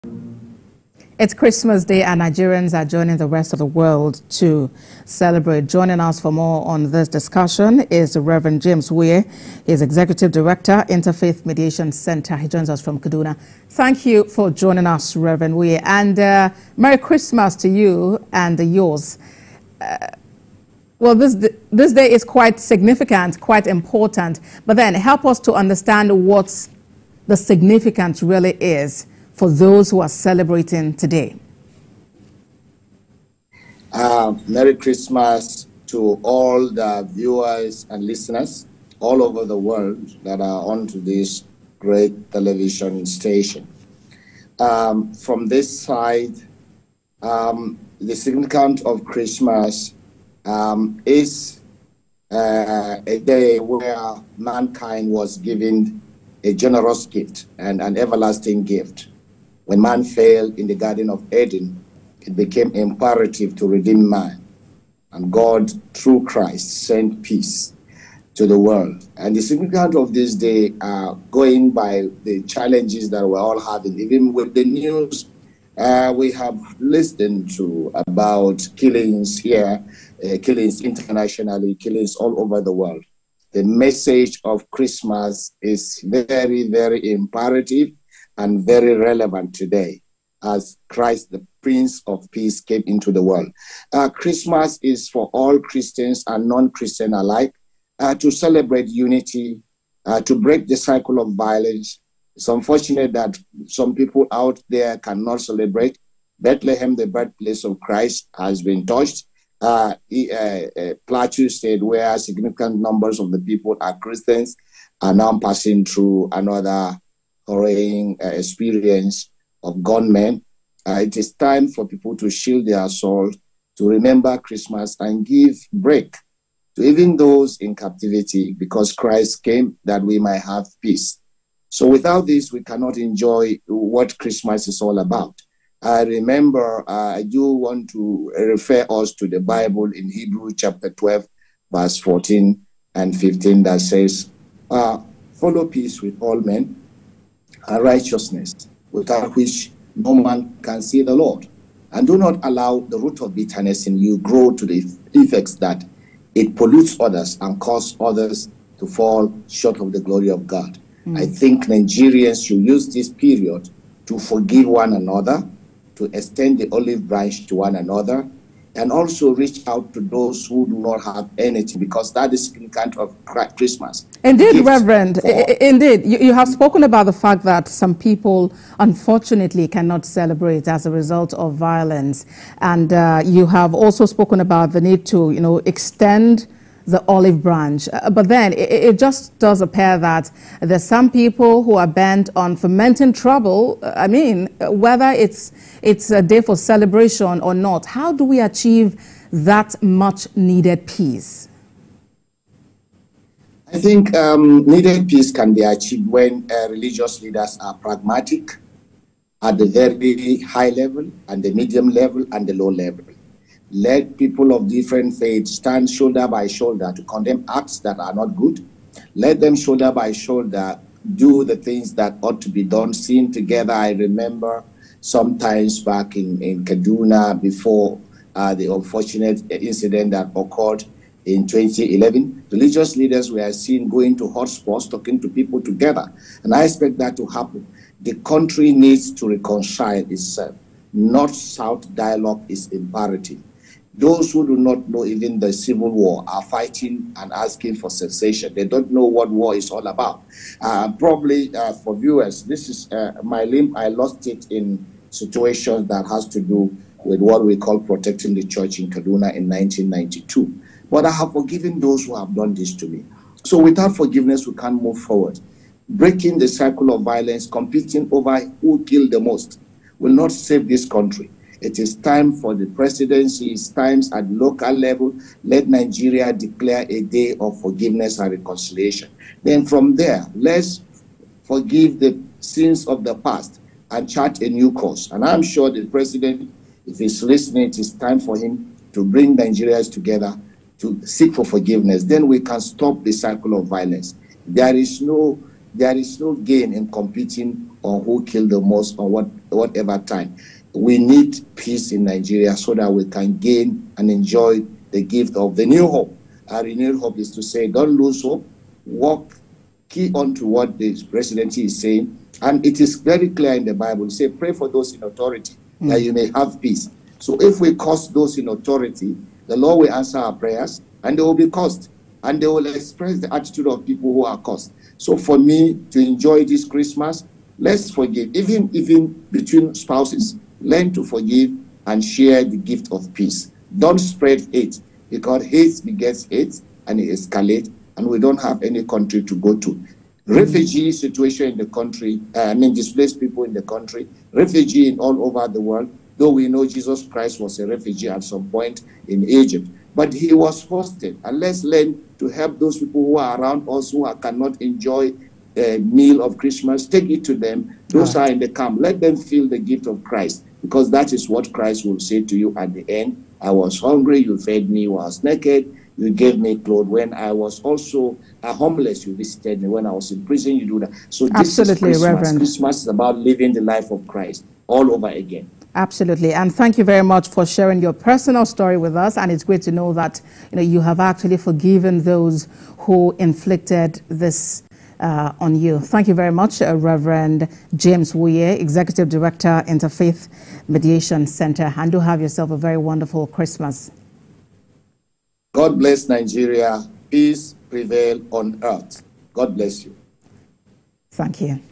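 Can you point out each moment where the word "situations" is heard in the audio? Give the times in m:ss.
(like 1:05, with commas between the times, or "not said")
4:15, 5:40.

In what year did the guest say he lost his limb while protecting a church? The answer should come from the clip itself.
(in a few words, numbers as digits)
1992.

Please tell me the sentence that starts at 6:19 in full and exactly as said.
And it's great to know that you, know, you have actually forgiven those who inflicted this uh, on you.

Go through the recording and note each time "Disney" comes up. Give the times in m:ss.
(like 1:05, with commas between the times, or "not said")
not said.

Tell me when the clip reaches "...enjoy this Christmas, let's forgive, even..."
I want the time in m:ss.
5:25.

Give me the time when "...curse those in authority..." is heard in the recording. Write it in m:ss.
5:17.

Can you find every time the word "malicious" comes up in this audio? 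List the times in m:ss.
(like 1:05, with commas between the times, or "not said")
not said.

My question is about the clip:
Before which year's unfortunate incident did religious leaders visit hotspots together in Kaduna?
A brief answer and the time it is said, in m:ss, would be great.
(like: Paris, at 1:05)
2011, at 3:51.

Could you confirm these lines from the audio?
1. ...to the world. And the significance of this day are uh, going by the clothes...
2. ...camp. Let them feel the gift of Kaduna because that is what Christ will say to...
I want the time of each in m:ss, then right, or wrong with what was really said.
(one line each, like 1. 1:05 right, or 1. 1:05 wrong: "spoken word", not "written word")
1. 1:08 wrong: "challenges", not "clothes"
2. 5:58 wrong: "Christ", not "Kaduna".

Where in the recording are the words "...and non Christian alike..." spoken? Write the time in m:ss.
1:36.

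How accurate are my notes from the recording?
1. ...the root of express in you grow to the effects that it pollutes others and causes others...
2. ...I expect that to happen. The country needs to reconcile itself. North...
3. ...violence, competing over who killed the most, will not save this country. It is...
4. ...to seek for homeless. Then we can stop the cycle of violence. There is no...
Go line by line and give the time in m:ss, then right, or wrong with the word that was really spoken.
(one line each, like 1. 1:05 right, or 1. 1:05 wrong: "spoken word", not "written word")
1. 2:32 wrong: "bitterness", not "express"
2. 3:56 right
3. 4:27 right
4. 4:50 wrong: "forgiveness", not "homeless".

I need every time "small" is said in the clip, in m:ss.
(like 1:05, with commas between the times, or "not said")
not said.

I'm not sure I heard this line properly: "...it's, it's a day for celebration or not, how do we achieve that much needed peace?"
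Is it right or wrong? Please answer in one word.
right.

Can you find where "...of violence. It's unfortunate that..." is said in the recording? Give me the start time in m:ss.
1:41.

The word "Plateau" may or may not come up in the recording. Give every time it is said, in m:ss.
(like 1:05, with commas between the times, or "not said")
1:51.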